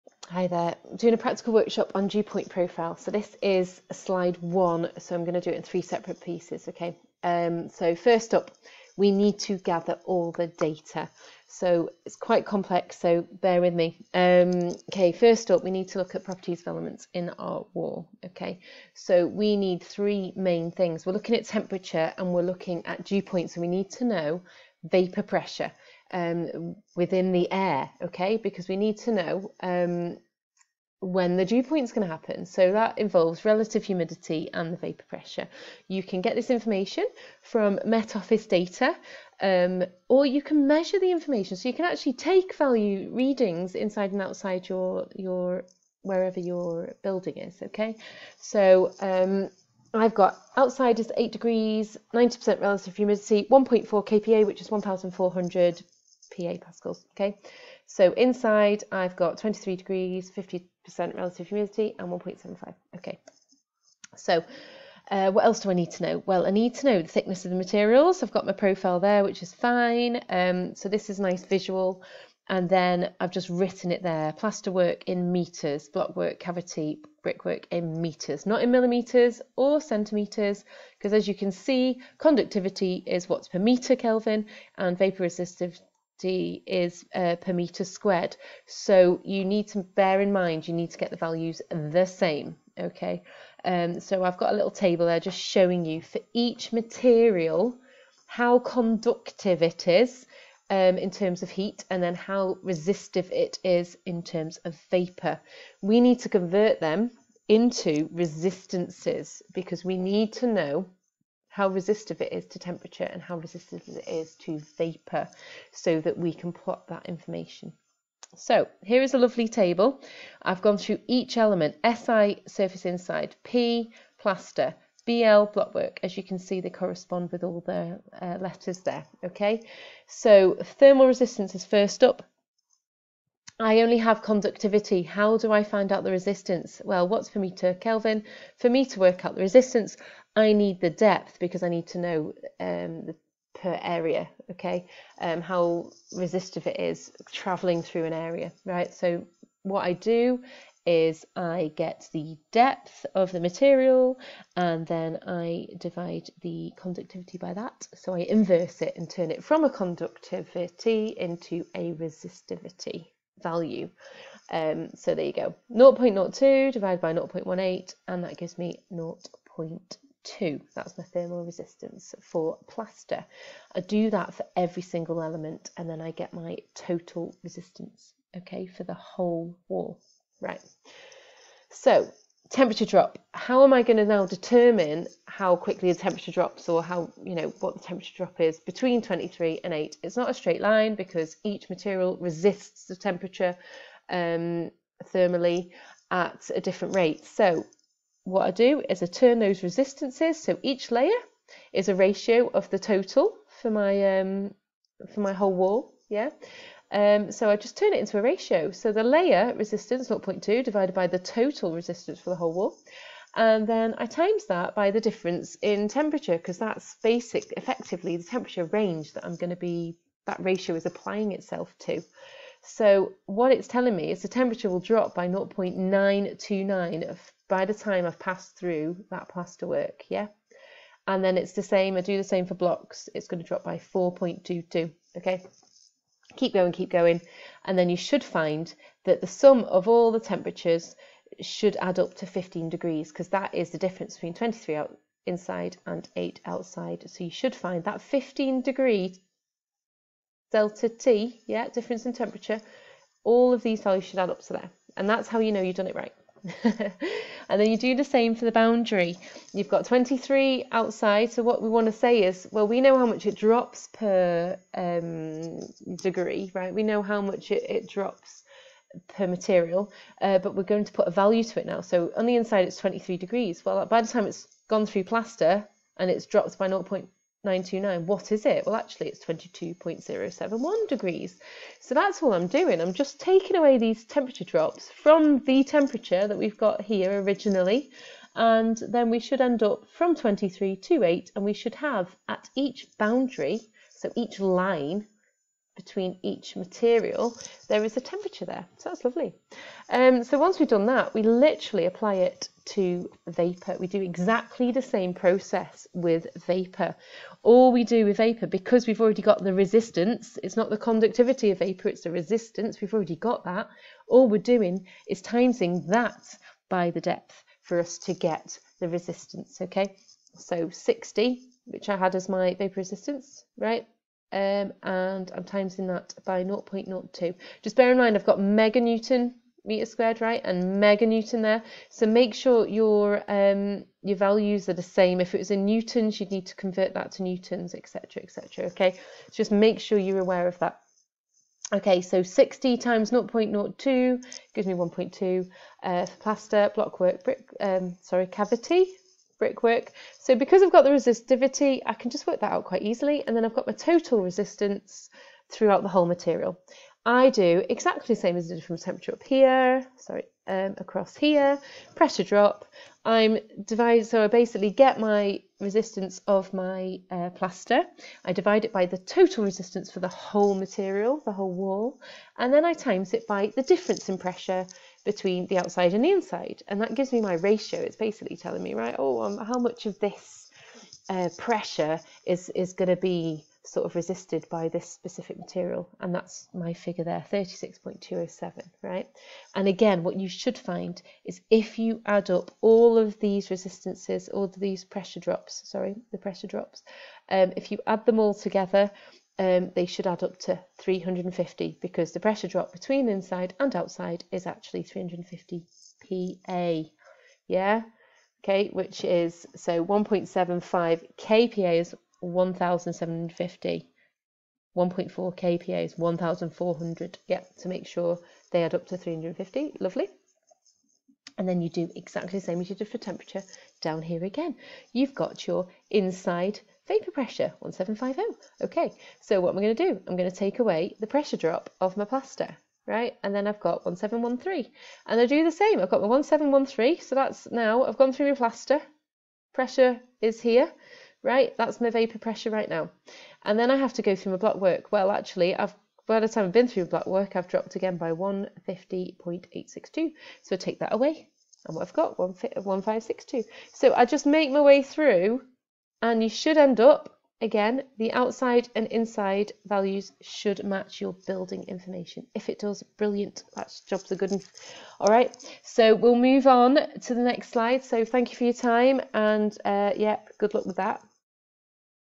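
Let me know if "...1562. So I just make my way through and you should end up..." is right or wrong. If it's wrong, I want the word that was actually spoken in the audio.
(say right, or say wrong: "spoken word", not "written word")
right.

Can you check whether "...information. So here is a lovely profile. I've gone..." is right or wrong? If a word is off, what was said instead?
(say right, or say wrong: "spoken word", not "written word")
wrong: "table", not "profile".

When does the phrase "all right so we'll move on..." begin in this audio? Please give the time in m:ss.
7:44.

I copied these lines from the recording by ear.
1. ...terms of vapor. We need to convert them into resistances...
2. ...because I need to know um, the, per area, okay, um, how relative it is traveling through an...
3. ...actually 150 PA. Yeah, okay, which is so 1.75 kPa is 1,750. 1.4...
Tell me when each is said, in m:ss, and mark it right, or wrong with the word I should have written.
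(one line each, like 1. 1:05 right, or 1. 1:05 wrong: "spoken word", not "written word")
1. 1:44 right
2. 2:21 wrong: "resistive", not "relative"
3. 6:44 wrong: "350", not "150".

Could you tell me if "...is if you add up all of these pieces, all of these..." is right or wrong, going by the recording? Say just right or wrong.
wrong.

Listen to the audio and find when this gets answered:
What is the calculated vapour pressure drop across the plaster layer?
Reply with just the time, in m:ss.
6:27.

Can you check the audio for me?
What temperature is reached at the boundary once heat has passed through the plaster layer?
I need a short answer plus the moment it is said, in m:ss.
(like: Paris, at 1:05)
22.071 degrees, at 4:39.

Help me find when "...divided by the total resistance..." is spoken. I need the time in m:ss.
3:30.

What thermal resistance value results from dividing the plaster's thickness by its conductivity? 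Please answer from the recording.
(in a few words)
0.2.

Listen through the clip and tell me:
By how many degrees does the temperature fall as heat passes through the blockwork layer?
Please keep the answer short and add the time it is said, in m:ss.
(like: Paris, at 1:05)
4.22, at 3:53.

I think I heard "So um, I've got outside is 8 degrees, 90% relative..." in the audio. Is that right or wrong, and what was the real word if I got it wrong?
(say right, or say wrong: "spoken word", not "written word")
right.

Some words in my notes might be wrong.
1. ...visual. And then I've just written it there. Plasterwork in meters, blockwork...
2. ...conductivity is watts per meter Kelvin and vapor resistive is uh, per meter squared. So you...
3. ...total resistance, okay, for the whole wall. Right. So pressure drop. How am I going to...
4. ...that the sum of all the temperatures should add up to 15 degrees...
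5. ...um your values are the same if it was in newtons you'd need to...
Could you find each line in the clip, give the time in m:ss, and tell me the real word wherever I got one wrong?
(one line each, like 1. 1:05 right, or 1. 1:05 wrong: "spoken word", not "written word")
1. 1:11 right
2. 1:22 right
3. 2:56 wrong: "temperature", not "pressure"
4. 3:59 right
5. 5:33 right.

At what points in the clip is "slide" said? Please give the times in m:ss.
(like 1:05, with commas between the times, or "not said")
0:03, 7:47.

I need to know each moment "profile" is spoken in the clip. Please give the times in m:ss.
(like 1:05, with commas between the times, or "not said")
0:02, 1:08.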